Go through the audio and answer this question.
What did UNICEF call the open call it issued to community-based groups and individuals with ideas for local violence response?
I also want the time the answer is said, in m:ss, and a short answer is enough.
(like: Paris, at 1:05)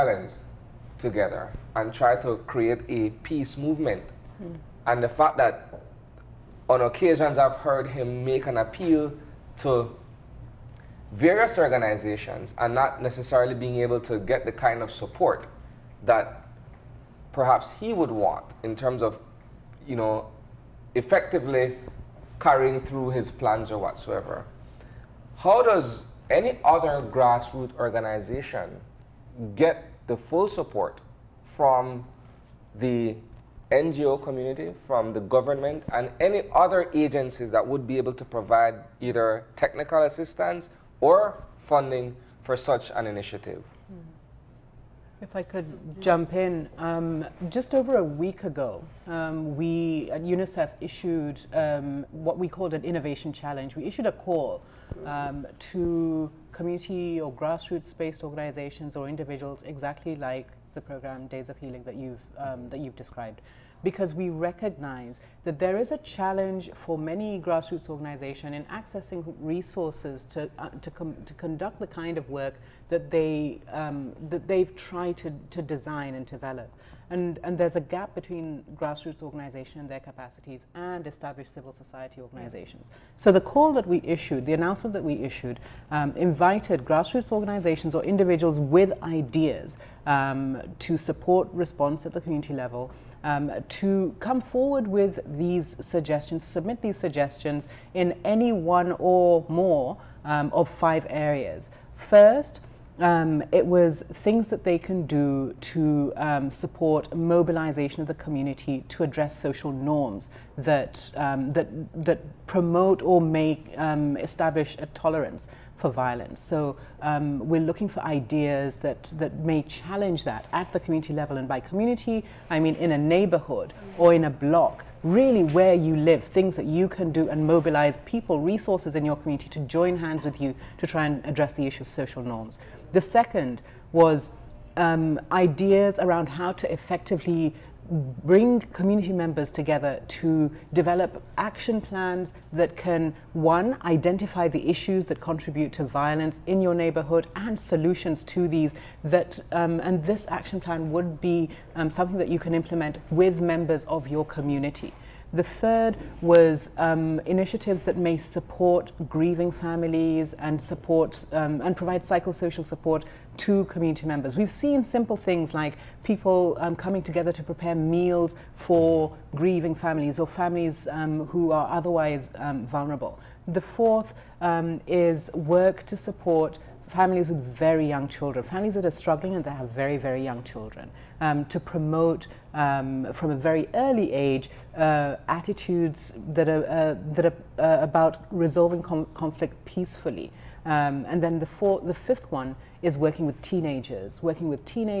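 innovation challenge, at 0:52.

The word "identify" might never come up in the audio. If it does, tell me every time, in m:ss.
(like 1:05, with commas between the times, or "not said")
2:23.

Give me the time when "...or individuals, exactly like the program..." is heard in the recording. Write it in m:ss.
0:58.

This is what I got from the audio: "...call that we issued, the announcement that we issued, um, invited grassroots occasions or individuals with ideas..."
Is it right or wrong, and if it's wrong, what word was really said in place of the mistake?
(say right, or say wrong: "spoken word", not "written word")
wrong: "organizations", not "occasions".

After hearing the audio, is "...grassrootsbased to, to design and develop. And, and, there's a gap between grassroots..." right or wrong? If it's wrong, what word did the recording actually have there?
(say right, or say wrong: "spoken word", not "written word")
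wrong: "tried", not "grassrootsbased".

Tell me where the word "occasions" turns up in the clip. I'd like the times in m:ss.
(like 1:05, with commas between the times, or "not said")
0:06.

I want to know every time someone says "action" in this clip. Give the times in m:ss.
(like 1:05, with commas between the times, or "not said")
2:21, 2:30.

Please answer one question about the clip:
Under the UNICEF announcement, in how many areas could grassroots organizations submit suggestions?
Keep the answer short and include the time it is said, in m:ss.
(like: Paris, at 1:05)
5, at 1:40.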